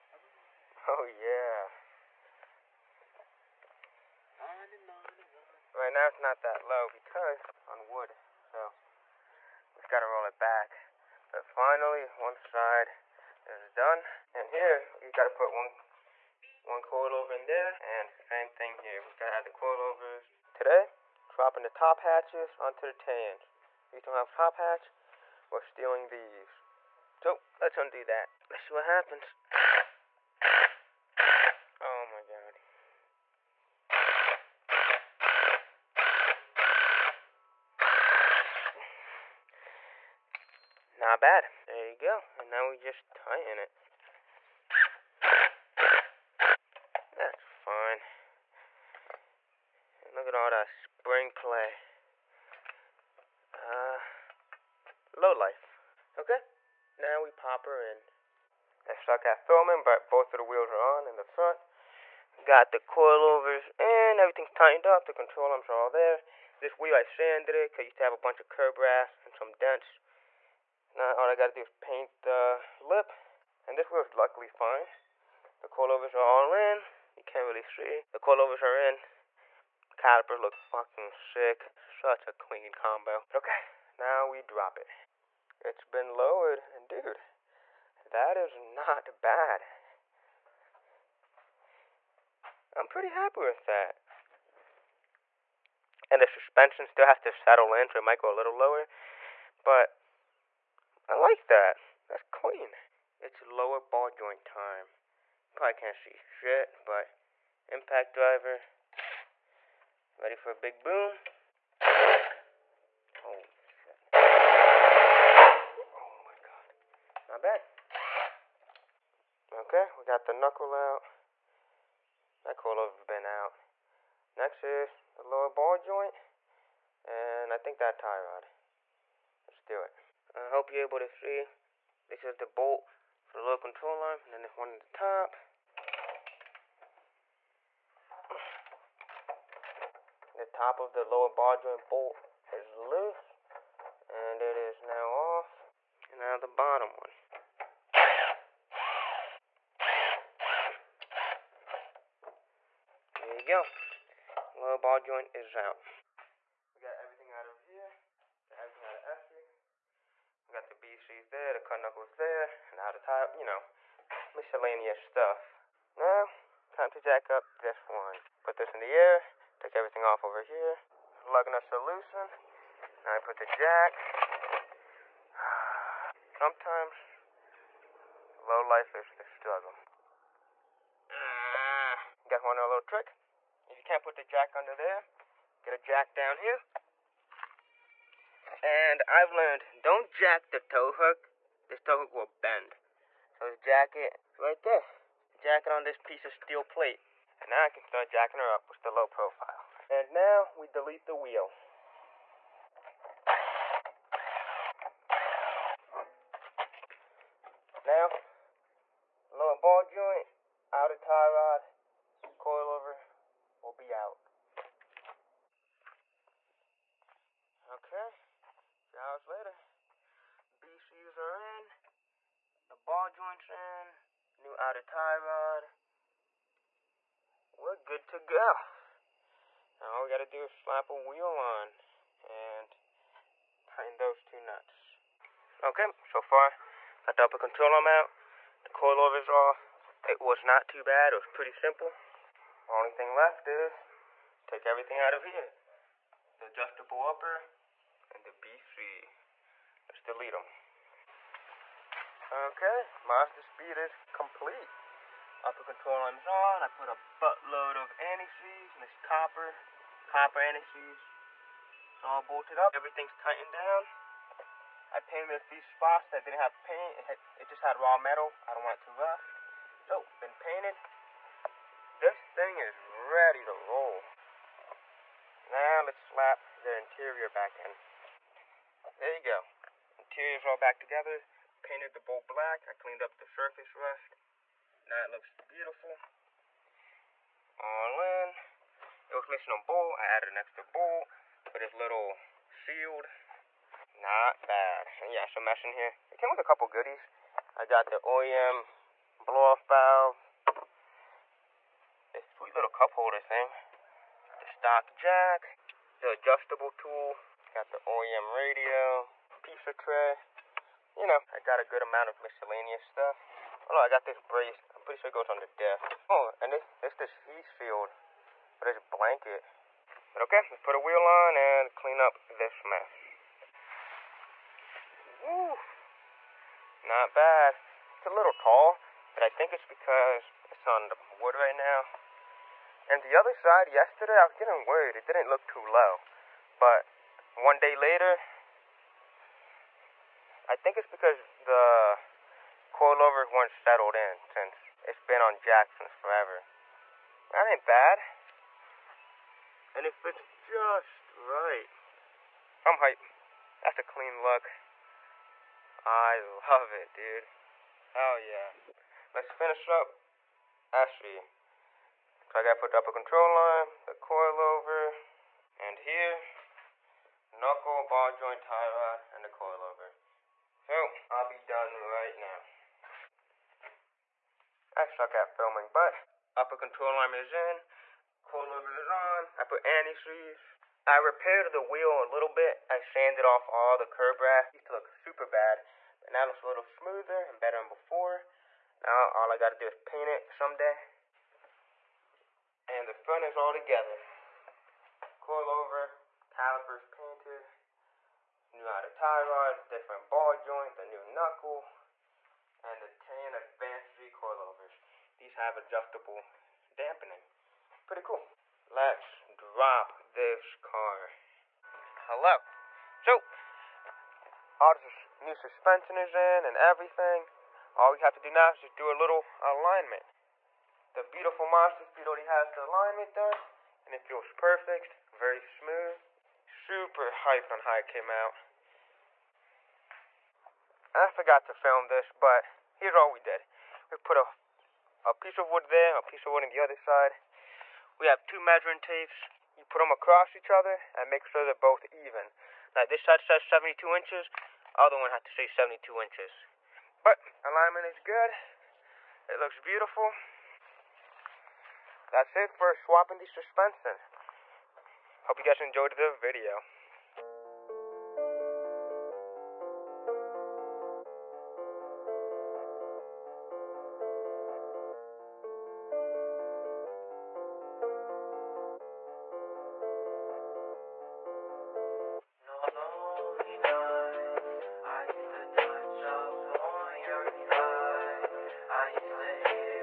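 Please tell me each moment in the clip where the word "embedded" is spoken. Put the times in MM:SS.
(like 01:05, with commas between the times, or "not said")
not said.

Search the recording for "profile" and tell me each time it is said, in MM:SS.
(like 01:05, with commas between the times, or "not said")
03:19.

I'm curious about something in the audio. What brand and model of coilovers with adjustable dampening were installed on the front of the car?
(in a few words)
Tein Advanced G.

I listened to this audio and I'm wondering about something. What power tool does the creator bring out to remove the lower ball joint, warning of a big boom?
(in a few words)
Impact driver.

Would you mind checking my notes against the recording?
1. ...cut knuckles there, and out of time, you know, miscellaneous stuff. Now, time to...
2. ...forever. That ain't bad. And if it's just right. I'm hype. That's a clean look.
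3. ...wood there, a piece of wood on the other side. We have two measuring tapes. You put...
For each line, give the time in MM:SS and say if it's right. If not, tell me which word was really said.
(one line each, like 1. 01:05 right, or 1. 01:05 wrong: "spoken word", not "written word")
1. 02:41 right
2. 05:45 right
3. 07:15 right.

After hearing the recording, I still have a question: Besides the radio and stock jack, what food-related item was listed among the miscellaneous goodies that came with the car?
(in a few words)
Pizza tray.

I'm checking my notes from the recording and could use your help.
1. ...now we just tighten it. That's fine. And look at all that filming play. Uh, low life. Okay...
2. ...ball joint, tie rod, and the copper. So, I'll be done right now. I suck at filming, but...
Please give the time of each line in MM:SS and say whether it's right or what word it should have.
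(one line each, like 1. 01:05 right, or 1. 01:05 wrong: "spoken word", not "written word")
1. 00:42 wrong: "spring", not "filming"
2. 06:07 wrong: "coilover", not "copper".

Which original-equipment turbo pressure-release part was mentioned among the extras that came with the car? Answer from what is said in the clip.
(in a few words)
OEM blow-off valve.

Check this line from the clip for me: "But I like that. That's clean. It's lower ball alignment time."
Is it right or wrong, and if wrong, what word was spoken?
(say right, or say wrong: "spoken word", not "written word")
wrong: "joint", not "alignment".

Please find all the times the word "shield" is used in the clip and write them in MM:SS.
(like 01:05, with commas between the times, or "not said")
04:52, 05:17.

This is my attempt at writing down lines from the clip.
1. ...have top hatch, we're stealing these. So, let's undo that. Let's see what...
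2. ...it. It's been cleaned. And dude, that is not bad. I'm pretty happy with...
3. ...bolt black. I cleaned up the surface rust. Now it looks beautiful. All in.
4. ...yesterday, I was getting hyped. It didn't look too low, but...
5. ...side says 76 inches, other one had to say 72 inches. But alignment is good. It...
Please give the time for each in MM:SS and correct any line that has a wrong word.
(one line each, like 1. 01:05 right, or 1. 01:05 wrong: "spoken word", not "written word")
1. 00:24 right
2. 01:24 wrong: "lowered", not "cleaned"
3. 04:41 right
4. 05:33 wrong: "worried", not "hyped"
5. 07:23 wrong: "72", not "76".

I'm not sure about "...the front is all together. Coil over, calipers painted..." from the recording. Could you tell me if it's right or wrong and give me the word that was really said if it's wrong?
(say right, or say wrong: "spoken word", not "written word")
right.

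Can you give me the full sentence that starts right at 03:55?
Okay, so far, got the upper control arm out, the coilover's off.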